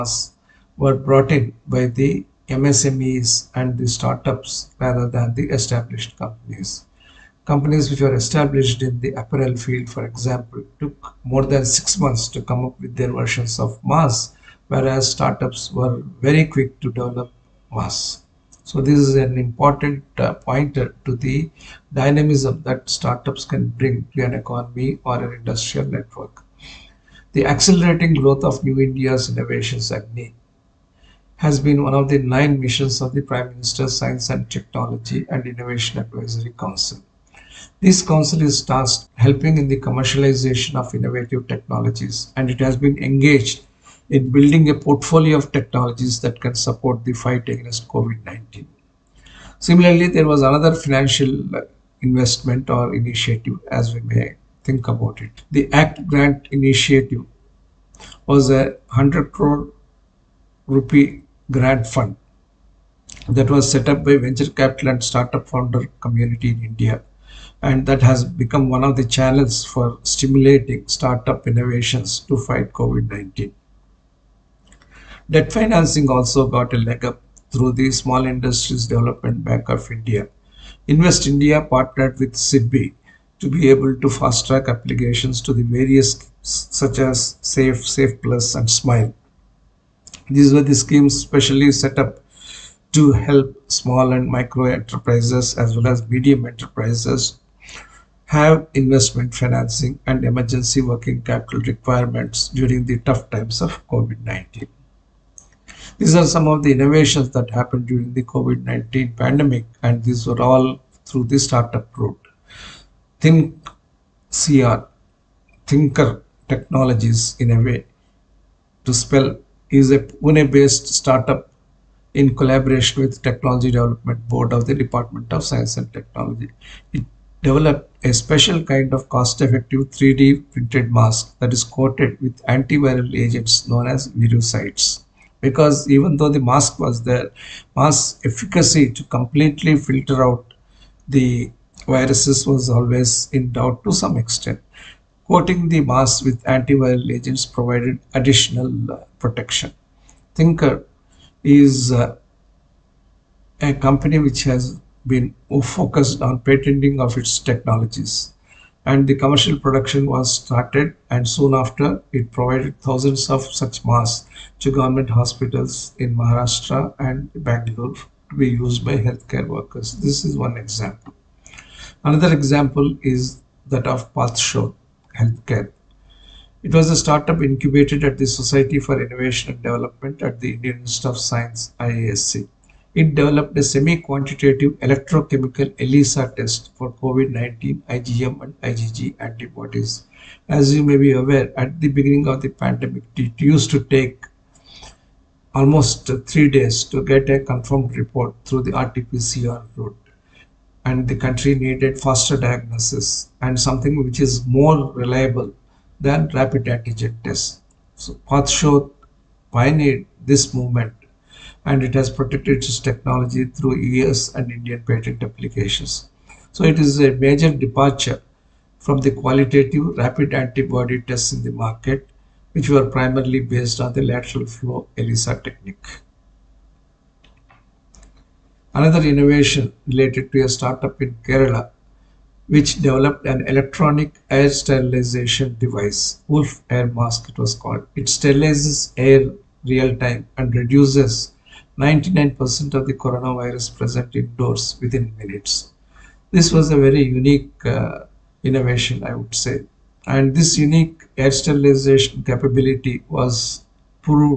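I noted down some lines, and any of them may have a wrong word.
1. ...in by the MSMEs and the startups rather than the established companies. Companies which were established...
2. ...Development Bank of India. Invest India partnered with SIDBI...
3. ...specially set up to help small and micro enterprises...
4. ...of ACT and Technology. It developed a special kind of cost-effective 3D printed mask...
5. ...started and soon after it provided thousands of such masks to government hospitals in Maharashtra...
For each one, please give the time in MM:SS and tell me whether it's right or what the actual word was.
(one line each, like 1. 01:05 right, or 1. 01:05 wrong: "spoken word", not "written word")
1. 00:01 right
2. 01:18 right
3. 01:31 right
4. 02:05 wrong: "Science", not "ACT"
5. 02:40 right.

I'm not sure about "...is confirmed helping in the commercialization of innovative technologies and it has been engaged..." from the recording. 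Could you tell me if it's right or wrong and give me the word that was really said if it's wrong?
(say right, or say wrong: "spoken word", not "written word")
wrong: "tasked", not "confirmed".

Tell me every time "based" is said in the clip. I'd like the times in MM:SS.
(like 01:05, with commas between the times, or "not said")
01:59, 03:43.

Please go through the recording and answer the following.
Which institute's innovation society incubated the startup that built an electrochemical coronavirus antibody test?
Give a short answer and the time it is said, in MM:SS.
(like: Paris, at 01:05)
Indian Institute of Science, at 03:00.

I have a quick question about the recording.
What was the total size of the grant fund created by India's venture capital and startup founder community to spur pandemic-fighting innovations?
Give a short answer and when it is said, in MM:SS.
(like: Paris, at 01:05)
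100 crore rupees, at 00:58.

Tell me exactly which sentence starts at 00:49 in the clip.
Similarly, there was another financial investment or initiative as we may think about it.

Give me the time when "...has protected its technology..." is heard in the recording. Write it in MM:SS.
03:32.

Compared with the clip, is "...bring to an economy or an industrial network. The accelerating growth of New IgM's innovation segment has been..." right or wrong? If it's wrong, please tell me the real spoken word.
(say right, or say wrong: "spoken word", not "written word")
wrong: "India", not "IgM".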